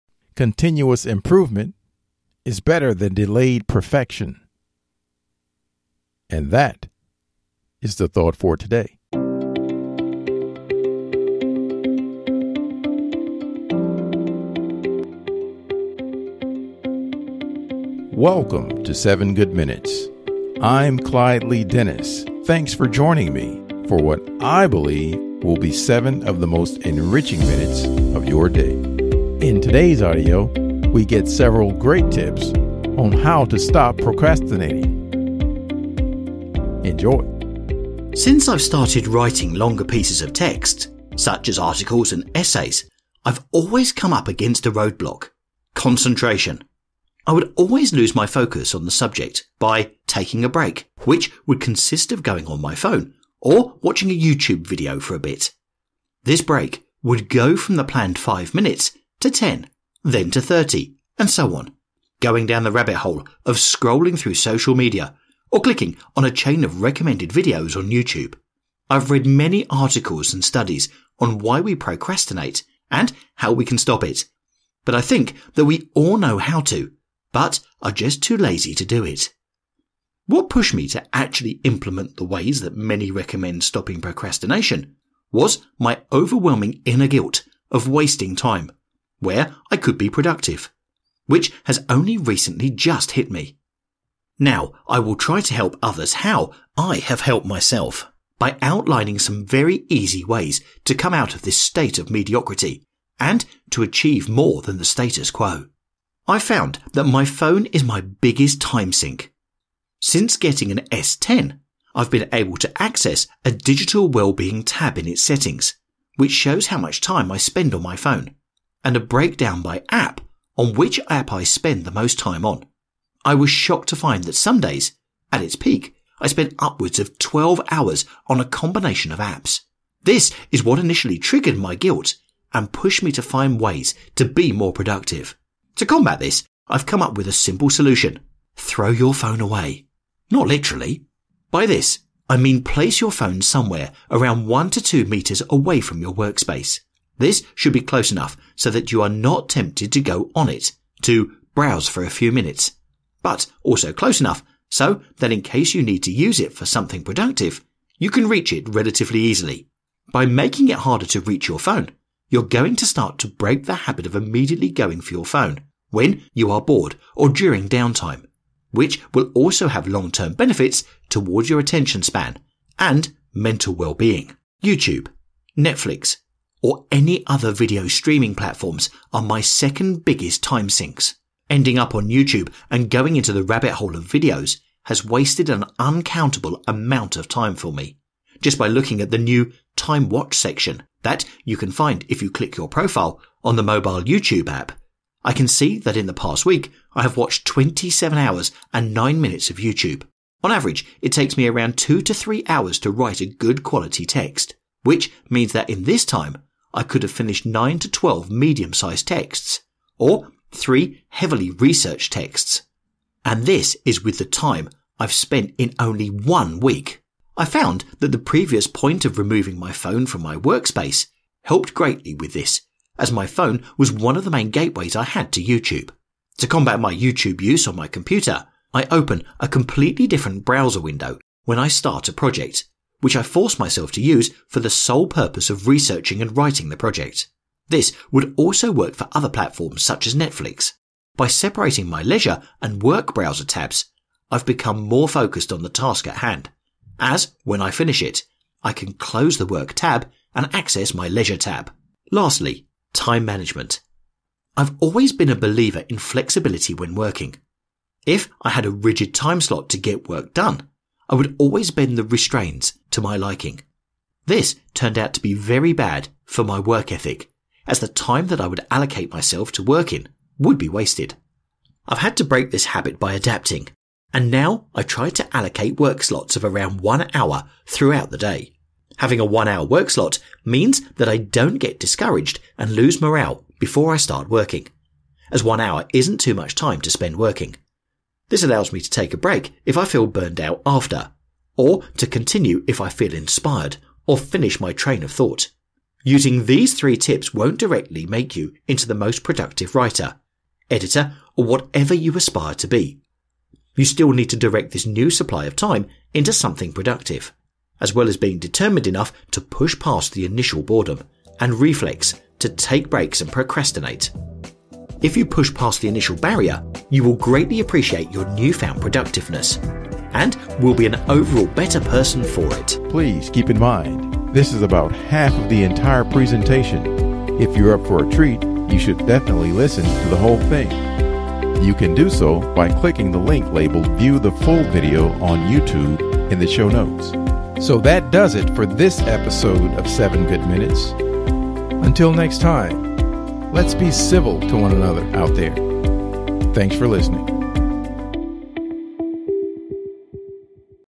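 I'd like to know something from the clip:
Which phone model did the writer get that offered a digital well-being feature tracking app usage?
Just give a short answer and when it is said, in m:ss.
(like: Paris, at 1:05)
S10, at 1:50.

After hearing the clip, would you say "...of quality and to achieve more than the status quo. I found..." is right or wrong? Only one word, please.
wrong.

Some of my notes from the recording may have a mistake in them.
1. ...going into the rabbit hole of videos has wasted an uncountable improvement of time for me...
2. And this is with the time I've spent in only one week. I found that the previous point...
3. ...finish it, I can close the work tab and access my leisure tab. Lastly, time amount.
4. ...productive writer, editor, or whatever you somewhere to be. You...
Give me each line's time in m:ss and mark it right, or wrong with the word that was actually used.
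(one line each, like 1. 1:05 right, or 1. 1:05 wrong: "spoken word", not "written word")
1. 3:02 wrong: "amount", not "improvement"
2. 3:33 right
3. 4:07 wrong: "management", not "amount"
4. 4:59 wrong: "aspire", not "somewhere".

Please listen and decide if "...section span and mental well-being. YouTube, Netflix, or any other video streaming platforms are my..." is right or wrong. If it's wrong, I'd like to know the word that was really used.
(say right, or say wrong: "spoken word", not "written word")
wrong: "attention", not "section".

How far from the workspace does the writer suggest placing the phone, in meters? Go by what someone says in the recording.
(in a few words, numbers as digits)
1 to 2 meters.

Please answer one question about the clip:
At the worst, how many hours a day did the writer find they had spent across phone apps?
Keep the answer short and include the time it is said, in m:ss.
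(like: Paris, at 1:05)
12 hours, at 2:07.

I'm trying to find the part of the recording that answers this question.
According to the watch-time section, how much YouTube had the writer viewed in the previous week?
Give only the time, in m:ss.
3:17.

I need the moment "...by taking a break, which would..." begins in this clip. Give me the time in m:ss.
0:49.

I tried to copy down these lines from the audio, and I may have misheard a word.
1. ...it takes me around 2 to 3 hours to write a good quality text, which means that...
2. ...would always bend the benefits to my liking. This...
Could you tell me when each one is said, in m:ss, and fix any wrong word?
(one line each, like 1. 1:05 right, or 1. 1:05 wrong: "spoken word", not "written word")
1. 3:21 right
2. 4:21 wrong: "restraints", not "benefits".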